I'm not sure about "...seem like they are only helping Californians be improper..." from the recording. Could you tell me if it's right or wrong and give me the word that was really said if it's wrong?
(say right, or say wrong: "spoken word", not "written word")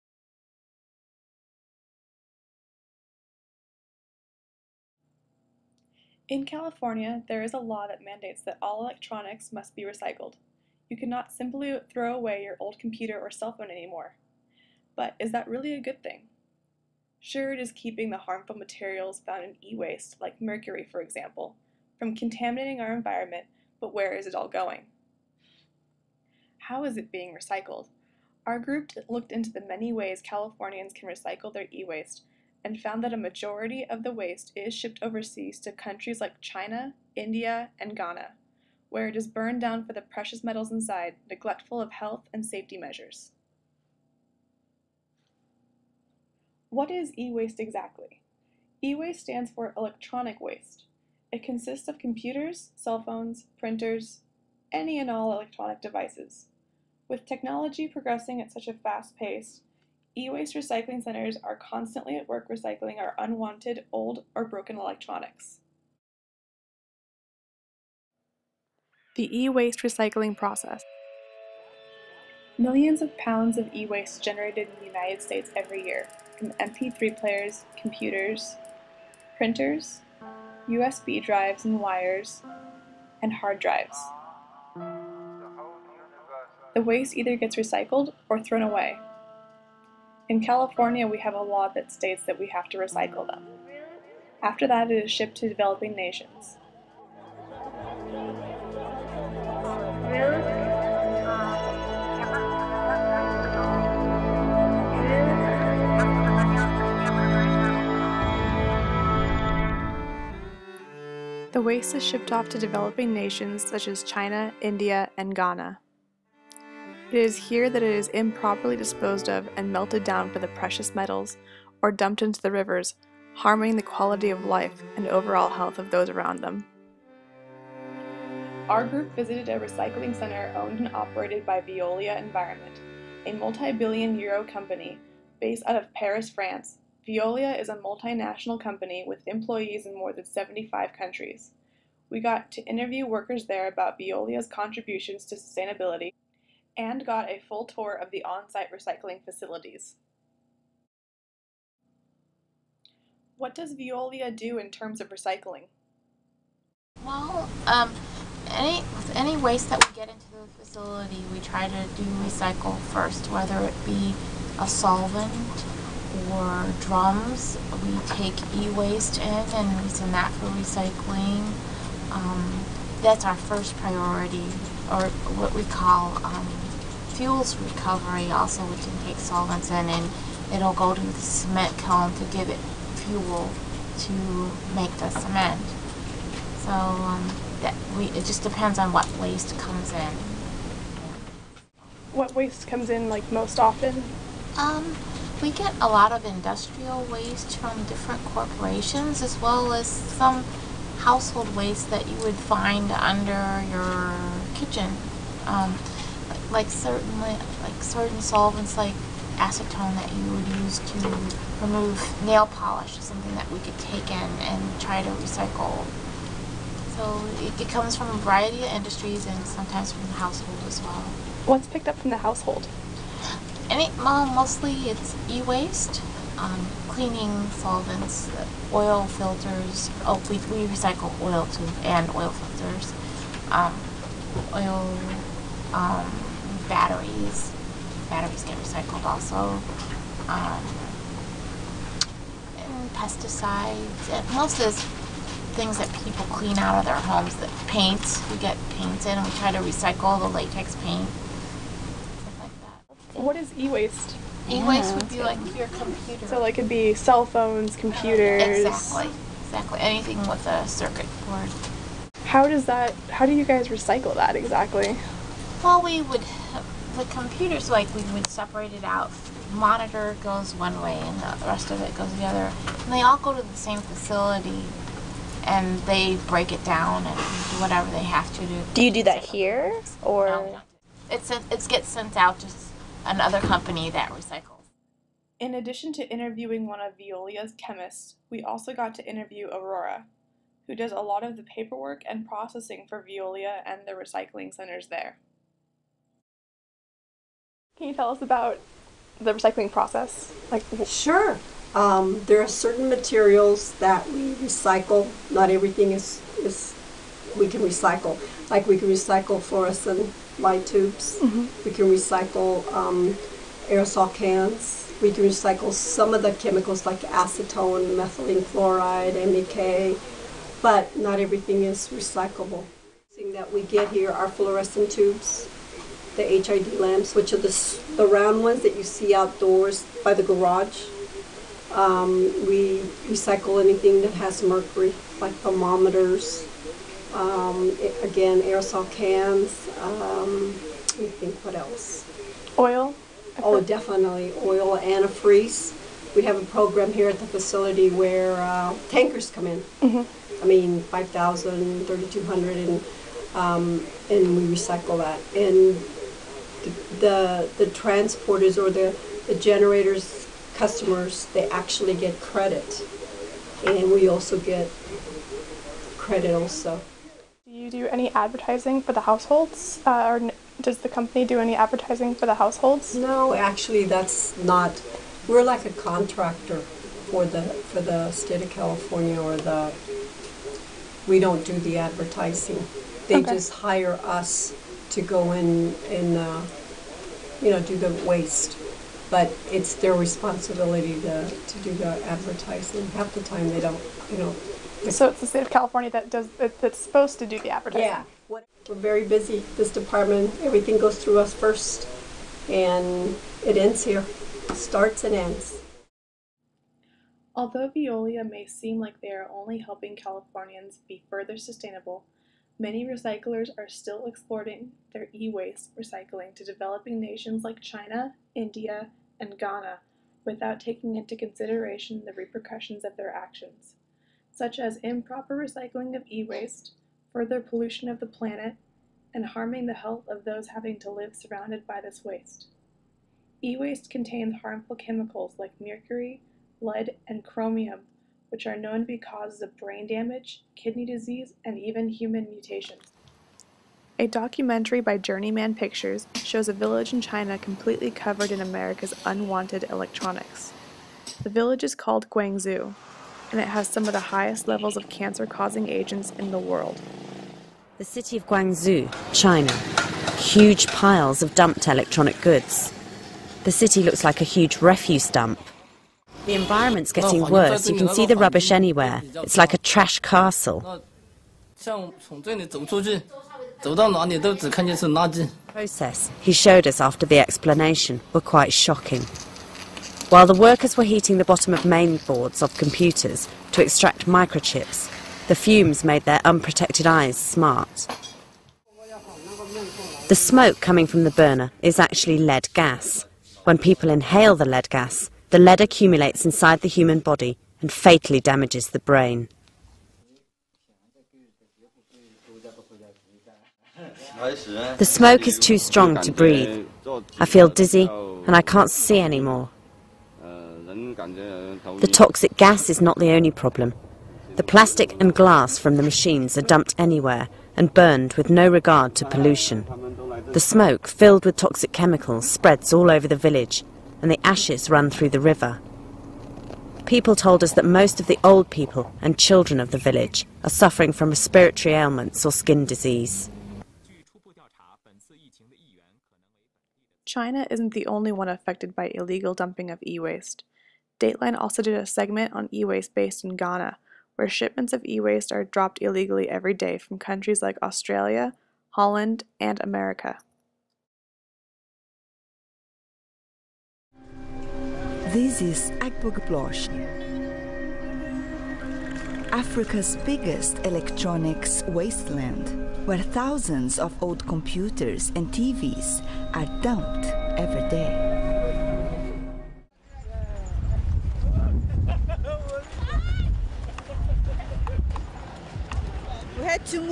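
wrong: "further", not "improper".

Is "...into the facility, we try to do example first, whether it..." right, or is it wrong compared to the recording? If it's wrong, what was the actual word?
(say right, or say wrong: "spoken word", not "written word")
wrong: "recycle", not "example".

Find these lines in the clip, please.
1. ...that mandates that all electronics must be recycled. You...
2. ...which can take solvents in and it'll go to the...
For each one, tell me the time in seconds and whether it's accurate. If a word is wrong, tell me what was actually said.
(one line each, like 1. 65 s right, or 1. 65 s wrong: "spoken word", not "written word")
1. 7 s right
2. 178 s right.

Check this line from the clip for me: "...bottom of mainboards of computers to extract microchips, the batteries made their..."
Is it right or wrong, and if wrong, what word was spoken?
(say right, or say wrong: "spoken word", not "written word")
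wrong: "fumes", not "batteries".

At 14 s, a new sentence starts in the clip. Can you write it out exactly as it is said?
But is that really a good thing?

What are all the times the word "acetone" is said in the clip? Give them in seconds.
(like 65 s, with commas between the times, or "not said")
209 s, 317 s.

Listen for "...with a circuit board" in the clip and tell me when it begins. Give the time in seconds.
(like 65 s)
260 s.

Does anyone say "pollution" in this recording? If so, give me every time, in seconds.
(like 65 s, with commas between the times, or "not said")
427 s, 519 s.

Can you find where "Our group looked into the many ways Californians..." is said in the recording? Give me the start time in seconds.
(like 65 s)
28 s.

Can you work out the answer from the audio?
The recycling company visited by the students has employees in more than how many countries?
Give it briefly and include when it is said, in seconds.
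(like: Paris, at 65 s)
75, at 140 s.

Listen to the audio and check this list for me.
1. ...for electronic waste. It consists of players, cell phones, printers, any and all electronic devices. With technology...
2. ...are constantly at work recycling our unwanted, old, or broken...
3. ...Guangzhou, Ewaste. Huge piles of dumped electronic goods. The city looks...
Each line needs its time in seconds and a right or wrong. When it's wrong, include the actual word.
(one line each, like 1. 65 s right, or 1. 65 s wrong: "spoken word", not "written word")
1. 49 s wrong: "computers", not "players"
2. 61 s right
3. 458 s wrong: "China", not "Ewaste".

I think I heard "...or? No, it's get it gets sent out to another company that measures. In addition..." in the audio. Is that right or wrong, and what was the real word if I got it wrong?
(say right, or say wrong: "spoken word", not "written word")
wrong: "recycles", not "measures".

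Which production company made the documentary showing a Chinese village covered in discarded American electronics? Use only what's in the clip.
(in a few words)
Journeyman Pictures.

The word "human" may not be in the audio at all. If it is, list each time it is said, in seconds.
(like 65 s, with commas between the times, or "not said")
441 s, 496 s.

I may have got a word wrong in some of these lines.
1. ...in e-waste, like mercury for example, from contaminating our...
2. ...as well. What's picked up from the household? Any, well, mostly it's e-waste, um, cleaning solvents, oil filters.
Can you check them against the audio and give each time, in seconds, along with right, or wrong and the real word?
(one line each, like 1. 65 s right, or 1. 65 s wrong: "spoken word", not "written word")
1. 19 s right
2. 220 s right.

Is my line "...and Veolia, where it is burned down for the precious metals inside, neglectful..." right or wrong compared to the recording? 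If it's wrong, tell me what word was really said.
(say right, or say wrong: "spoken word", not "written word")
wrong: "Ghana", not "Veolia".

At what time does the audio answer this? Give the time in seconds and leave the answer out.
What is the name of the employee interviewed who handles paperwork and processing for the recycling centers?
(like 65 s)
289 s.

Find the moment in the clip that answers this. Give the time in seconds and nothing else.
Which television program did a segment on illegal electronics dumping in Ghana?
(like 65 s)
540 s.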